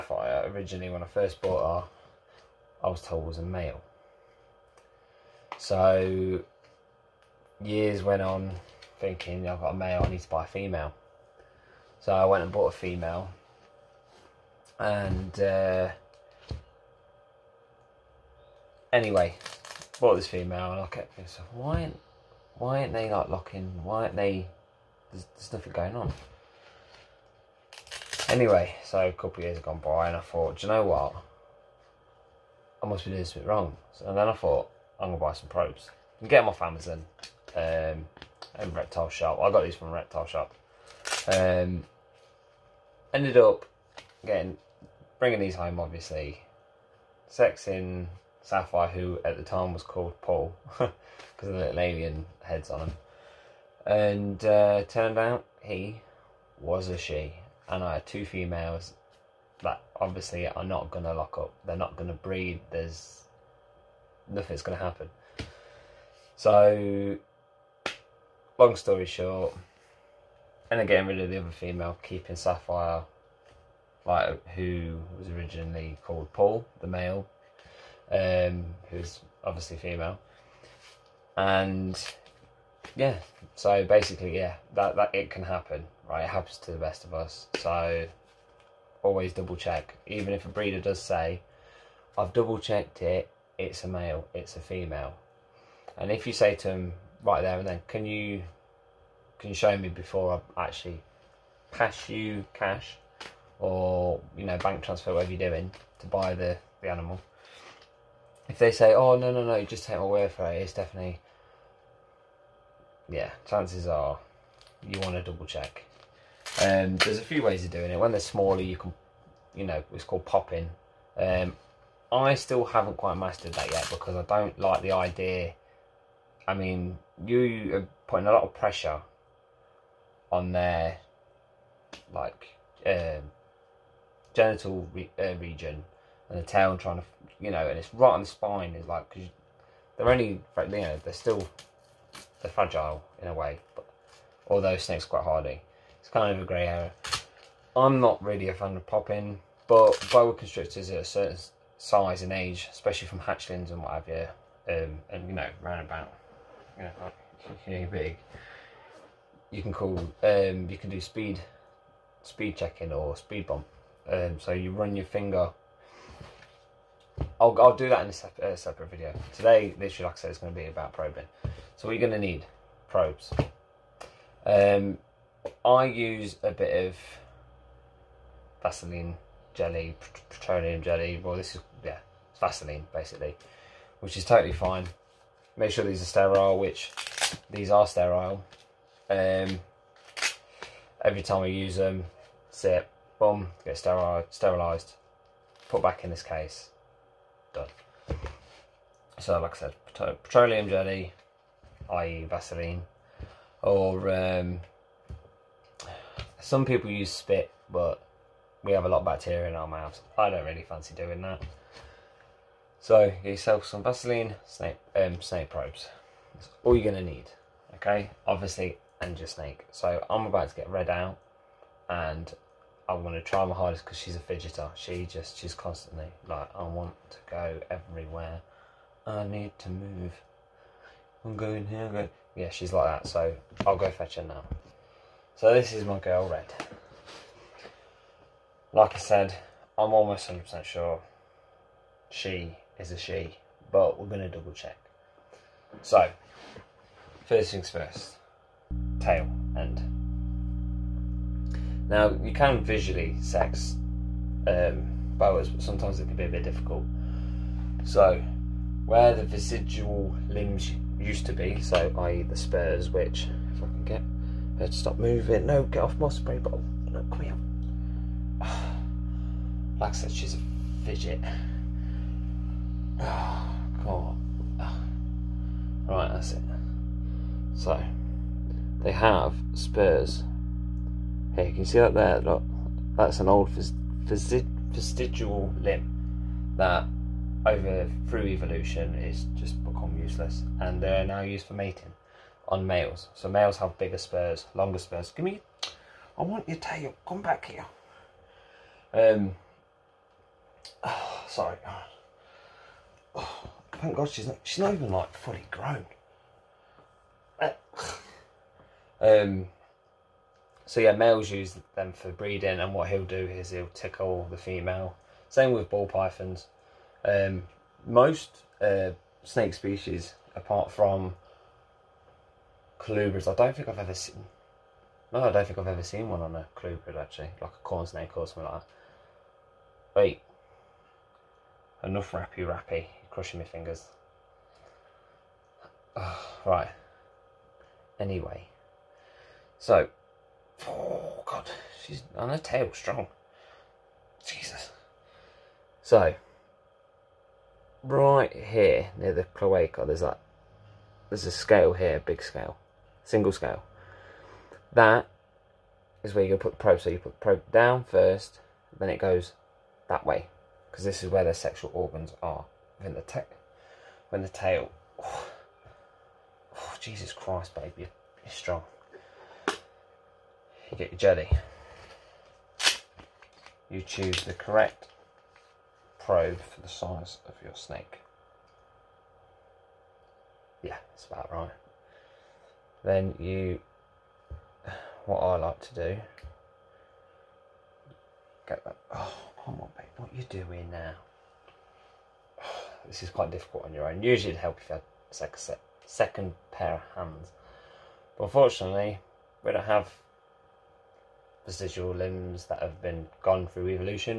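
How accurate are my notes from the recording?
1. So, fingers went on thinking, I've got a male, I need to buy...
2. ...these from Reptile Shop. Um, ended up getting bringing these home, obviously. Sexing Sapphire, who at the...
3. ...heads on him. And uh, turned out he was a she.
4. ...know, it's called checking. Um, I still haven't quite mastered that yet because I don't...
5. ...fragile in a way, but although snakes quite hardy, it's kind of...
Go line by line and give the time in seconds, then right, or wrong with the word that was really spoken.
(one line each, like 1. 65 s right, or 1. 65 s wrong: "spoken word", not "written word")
1. 5 s wrong: "years", not "fingers"
2. 39 s right
3. 52 s right
4. 119 s wrong: "popping", not "checking"
5. 142 s right.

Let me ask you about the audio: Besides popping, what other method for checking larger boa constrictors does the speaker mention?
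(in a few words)
speed bump.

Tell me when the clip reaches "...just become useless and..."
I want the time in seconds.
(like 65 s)
289 s.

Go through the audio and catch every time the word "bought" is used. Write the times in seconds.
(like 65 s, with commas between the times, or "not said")
1 s, 12 s, 20 s.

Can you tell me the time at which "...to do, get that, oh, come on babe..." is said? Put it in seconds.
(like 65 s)
385 s.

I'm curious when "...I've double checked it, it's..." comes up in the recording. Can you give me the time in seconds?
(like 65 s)
92 s.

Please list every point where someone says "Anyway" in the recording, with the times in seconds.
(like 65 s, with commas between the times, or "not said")
18 s, 28 s, 337 s.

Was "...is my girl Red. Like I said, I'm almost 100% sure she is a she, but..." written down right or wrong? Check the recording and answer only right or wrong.
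right.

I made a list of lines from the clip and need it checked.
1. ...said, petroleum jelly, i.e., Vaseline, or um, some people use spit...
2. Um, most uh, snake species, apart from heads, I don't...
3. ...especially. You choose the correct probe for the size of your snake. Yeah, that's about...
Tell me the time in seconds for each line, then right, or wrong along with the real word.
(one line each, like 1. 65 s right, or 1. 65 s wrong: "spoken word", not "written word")
1. 199 s right
2. 317 s wrong: "colubrids", not "heads"
3. 370 s wrong: "jelly", not "especially".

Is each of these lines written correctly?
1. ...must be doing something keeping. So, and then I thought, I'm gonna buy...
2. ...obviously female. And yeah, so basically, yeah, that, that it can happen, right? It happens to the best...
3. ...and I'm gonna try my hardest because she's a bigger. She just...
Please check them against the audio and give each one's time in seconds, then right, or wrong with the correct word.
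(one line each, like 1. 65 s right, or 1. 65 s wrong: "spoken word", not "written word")
1. 32 s wrong: "wrong", not "keeping"
2. 79 s right
3. 221 s wrong: "fidgeter", not "bigger".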